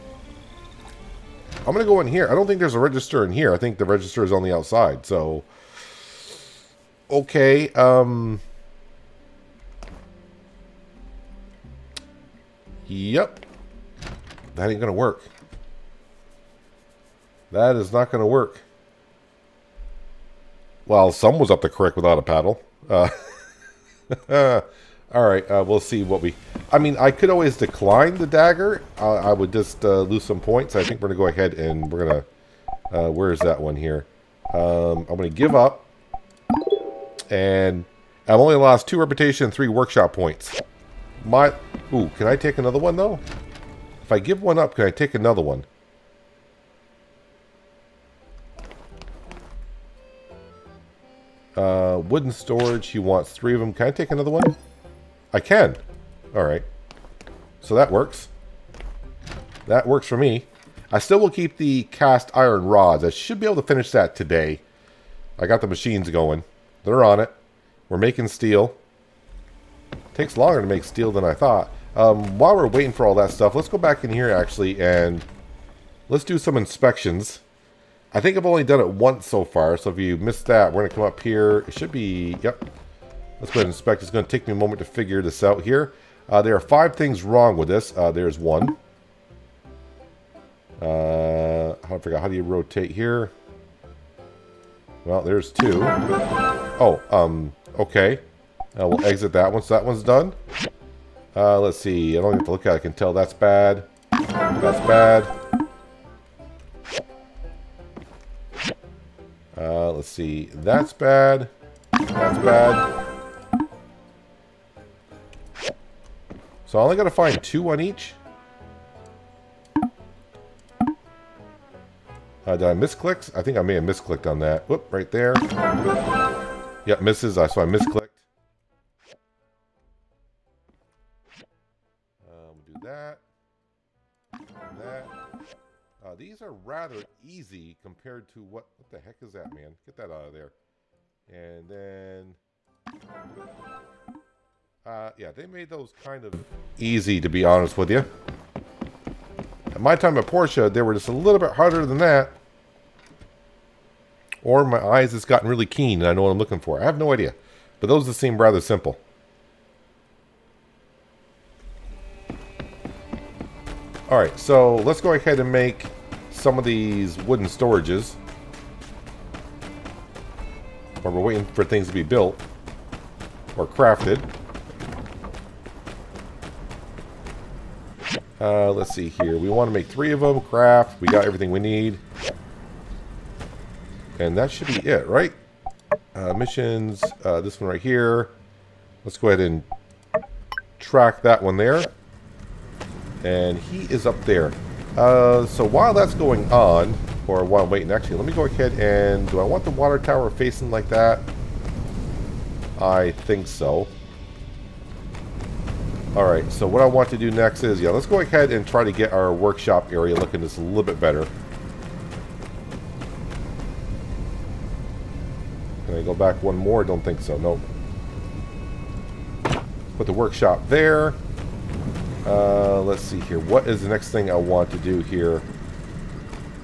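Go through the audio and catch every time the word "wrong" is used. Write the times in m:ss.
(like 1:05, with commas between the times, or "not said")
1:27.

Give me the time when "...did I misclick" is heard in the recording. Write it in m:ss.
2:02.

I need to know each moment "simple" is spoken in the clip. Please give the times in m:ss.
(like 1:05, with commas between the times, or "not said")
2:38.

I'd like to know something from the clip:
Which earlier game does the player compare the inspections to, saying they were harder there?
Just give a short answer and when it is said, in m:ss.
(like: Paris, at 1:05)
My Time at Portia, at 2:29.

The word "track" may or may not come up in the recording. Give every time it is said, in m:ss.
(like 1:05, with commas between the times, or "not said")
3:10.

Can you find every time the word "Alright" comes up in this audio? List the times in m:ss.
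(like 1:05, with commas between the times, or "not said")
2:44, 3:26.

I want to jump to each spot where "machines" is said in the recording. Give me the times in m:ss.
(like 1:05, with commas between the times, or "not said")
1:05.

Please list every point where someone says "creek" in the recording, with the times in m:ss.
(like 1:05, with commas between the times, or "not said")
0:21.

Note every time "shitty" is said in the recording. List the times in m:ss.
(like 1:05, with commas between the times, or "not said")
not said.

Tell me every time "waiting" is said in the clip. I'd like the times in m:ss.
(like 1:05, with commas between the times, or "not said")
1:12, 2:51, 3:17.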